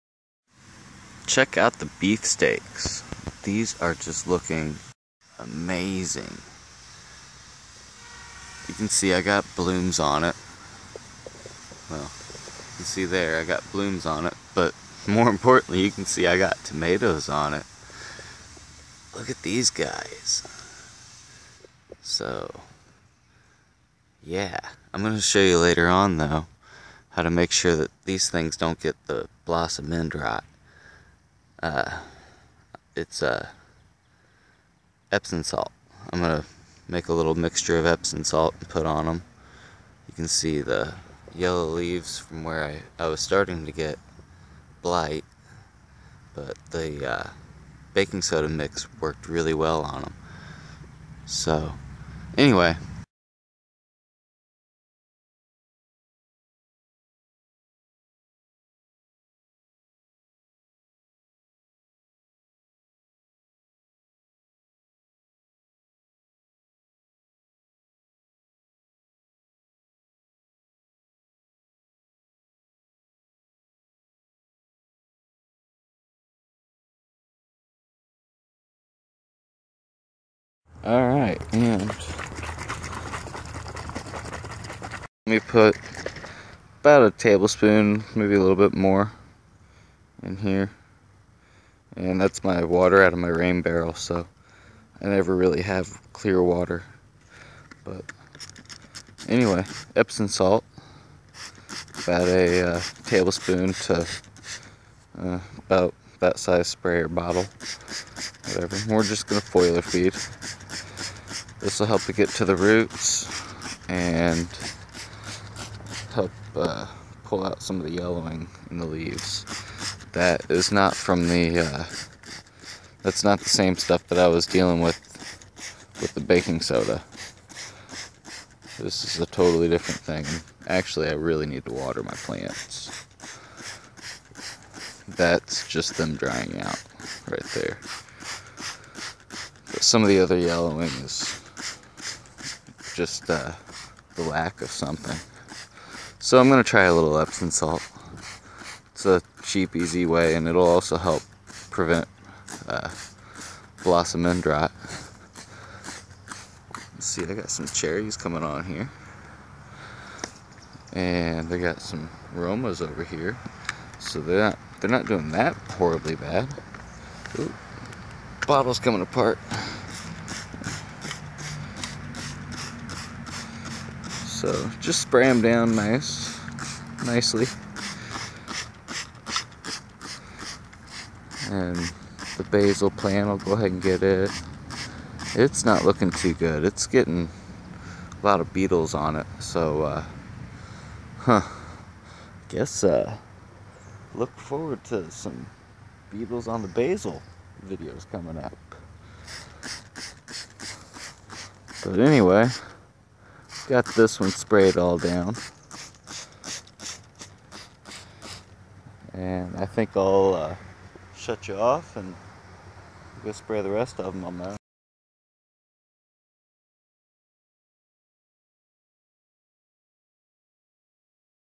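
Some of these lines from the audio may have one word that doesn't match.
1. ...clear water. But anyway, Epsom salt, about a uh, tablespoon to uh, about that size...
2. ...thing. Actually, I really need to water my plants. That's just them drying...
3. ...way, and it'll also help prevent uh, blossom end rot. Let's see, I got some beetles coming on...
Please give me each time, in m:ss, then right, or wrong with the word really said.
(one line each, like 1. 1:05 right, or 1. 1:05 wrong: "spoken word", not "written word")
1. 1:36 right
2. 2:09 right
3. 2:30 wrong: "cherries", not "beetles".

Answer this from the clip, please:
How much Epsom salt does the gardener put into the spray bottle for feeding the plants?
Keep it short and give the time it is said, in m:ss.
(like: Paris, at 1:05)
a tablespoon, at 1:26.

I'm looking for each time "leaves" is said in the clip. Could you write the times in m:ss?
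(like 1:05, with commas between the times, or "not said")
0:41, 1:58.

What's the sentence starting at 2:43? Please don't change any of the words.
So they're not they're not doing that horribly bad.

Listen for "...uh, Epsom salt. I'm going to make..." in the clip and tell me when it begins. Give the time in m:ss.
0:33.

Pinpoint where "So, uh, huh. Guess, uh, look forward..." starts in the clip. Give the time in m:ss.
3:09.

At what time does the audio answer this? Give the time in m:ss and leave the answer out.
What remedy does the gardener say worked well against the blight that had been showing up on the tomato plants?
0:47.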